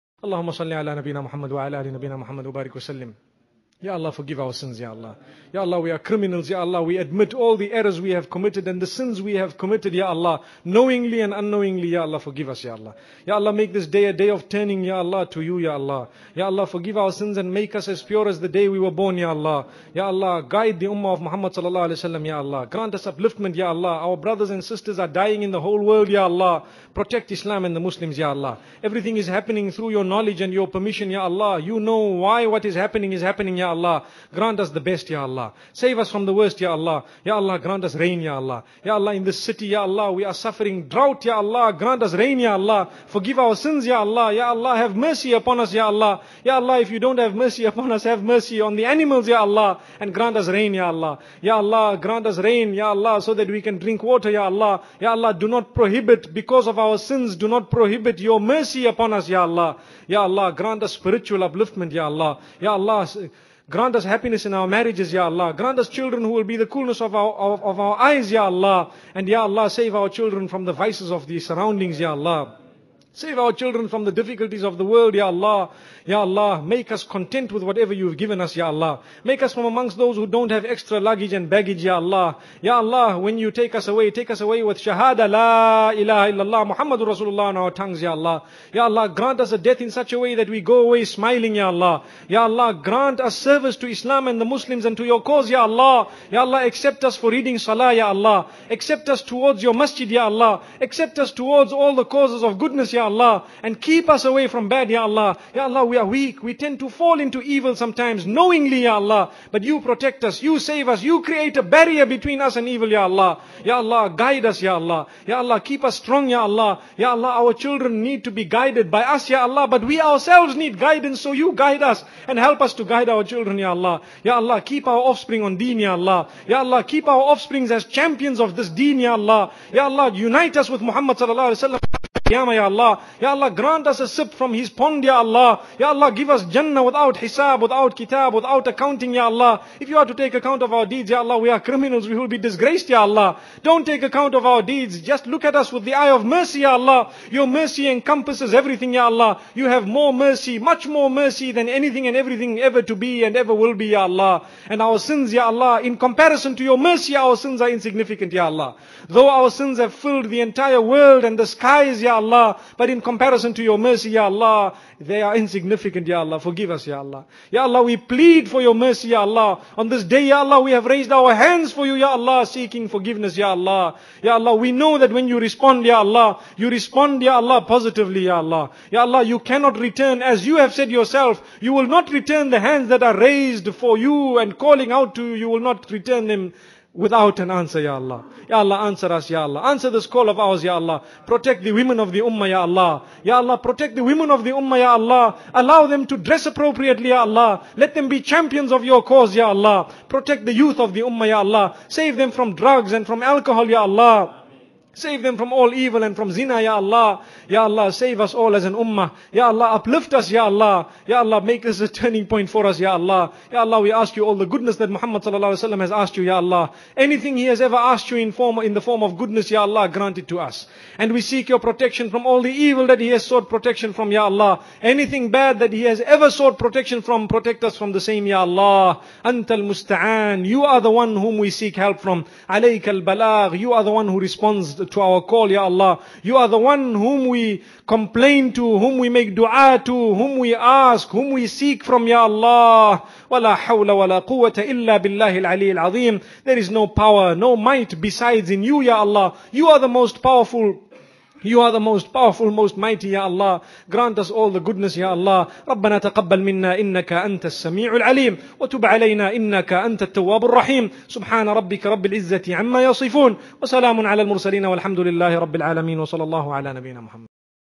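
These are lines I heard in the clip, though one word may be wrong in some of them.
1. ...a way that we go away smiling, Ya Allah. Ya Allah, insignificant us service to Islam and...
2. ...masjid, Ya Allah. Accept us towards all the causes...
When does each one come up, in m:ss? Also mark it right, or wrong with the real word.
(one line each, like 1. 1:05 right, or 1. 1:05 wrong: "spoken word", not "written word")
1. 1:30 wrong: "grant", not "insignificant"
2. 1:39 right.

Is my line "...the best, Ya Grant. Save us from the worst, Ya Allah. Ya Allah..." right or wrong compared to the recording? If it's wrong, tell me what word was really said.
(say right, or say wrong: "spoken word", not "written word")
wrong: "Allah", not "Grant".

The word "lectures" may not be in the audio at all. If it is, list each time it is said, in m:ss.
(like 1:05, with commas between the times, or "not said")
not said.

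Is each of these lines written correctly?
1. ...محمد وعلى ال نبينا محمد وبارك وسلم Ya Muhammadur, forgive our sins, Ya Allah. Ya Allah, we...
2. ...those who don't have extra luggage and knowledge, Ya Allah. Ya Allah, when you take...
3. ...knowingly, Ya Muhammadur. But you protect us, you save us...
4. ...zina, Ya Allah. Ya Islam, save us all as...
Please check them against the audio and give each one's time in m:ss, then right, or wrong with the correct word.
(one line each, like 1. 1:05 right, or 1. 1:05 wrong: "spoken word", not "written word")
1. 0:01 wrong: "Allah", not "Muhammadur"
2. 1:19 wrong: "baggage", not "knowledge"
3. 1:48 wrong: "Allah", not "Muhammadur"
4. 3:26 wrong: "Allah", not "Islam".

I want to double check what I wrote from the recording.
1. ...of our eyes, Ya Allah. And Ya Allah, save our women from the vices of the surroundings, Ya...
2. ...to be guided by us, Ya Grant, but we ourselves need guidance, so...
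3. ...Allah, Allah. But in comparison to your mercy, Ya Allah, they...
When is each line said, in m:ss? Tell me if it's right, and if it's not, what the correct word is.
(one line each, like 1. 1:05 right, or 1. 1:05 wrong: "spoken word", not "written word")
1. 1:07 wrong: "children", not "women"
2. 1:58 wrong: "Allah", not "Grant"
3. 2:42 right.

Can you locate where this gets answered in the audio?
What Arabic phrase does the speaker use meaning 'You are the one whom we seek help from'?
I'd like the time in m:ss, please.
3:49.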